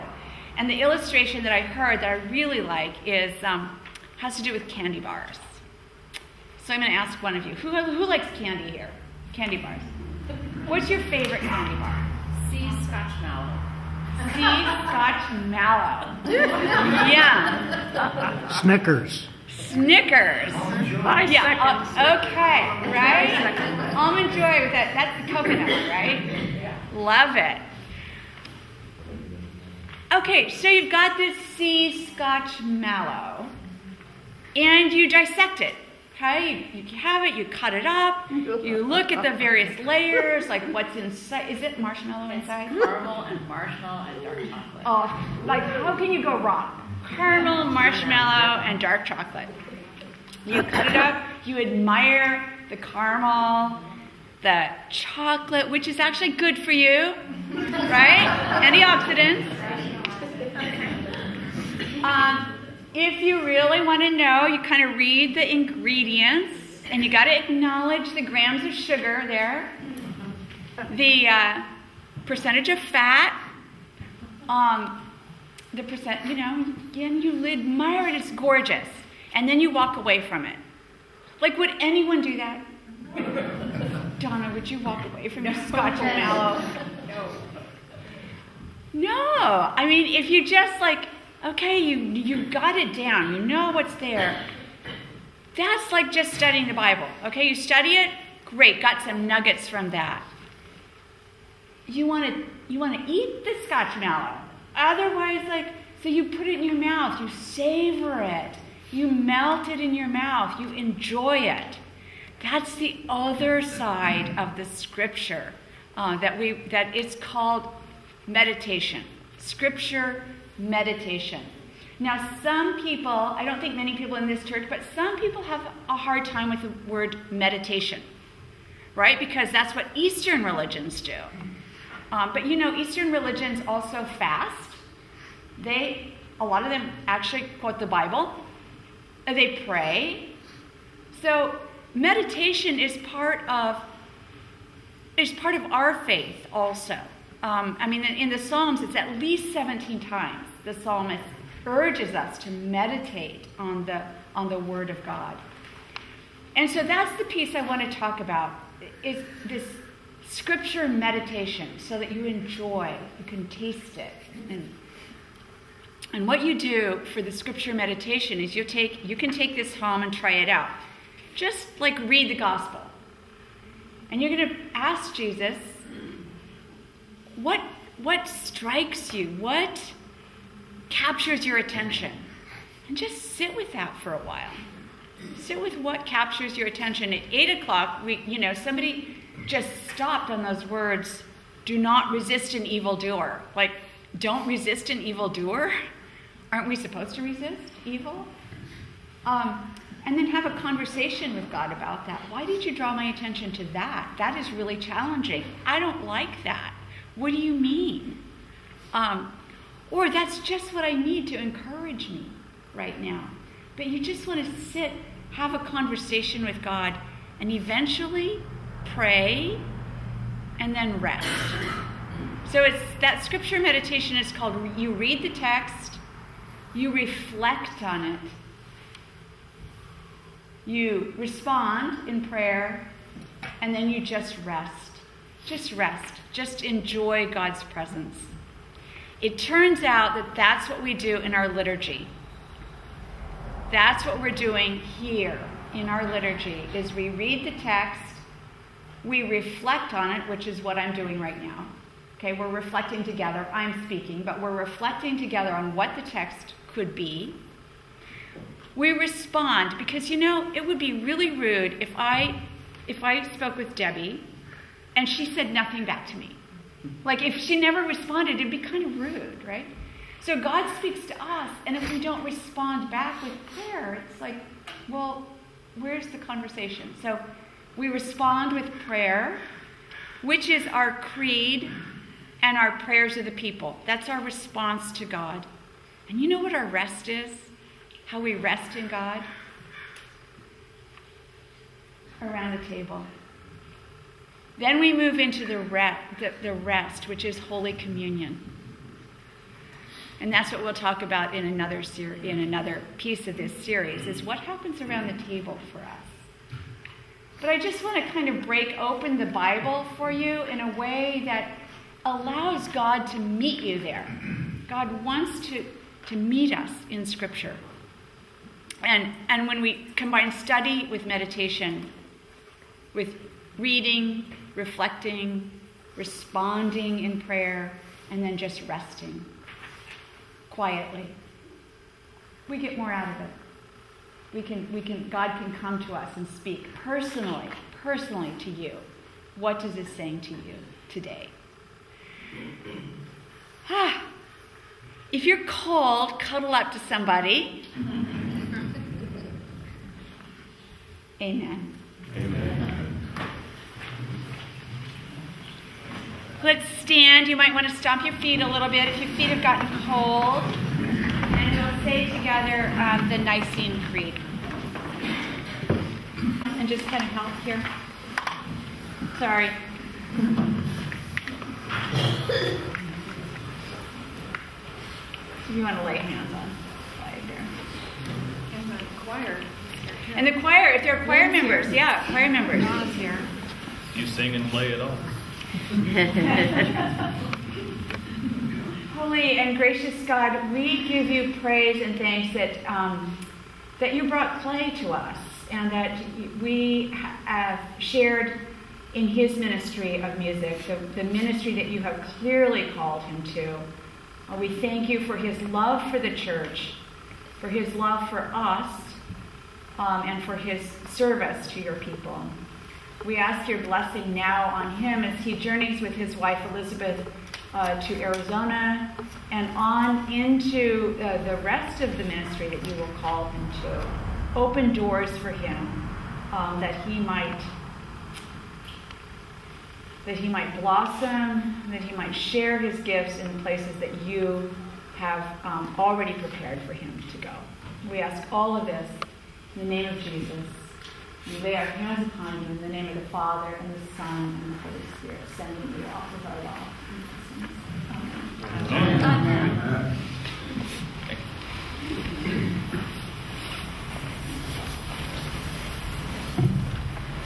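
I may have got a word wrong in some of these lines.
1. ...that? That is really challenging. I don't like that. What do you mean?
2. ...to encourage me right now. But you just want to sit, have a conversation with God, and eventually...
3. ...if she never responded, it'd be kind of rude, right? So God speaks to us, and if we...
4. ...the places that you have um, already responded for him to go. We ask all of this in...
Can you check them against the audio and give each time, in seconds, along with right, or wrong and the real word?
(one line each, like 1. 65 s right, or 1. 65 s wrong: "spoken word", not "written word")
1. 203 s right
2. 211 s right
3. 267 s right
4. 433 s wrong: "prepared", not "responded".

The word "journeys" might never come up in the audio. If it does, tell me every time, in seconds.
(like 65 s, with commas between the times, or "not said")
415 s.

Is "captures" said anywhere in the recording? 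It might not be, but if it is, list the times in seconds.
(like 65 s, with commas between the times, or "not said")
180 s, 186 s.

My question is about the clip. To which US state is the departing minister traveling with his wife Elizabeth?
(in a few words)
Arizona.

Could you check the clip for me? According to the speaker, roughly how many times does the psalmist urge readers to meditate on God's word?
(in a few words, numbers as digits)
17.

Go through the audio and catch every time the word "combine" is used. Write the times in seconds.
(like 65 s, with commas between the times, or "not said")
319 s.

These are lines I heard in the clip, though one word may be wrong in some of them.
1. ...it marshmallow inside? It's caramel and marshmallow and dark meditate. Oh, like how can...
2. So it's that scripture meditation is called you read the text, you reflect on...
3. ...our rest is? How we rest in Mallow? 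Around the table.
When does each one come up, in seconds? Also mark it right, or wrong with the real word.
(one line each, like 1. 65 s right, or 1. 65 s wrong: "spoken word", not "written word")
1. 41 s wrong: "chocolate", not "meditate"
2. 222 s right
3. 286 s wrong: "God", not "Mallow".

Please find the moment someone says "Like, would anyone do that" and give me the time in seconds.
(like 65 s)
81 s.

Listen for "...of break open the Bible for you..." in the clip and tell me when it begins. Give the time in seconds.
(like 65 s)
308 s.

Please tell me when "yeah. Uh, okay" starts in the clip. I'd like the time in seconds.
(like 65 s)
21 s.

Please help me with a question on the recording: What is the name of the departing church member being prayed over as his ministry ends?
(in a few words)
Clay.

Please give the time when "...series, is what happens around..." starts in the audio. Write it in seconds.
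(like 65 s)
303 s.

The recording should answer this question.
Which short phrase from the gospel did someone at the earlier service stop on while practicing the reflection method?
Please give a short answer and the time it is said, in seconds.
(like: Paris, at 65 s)
Do not resist an evildoer, at 191 s.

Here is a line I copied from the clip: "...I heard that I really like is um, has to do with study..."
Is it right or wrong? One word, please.
wrong.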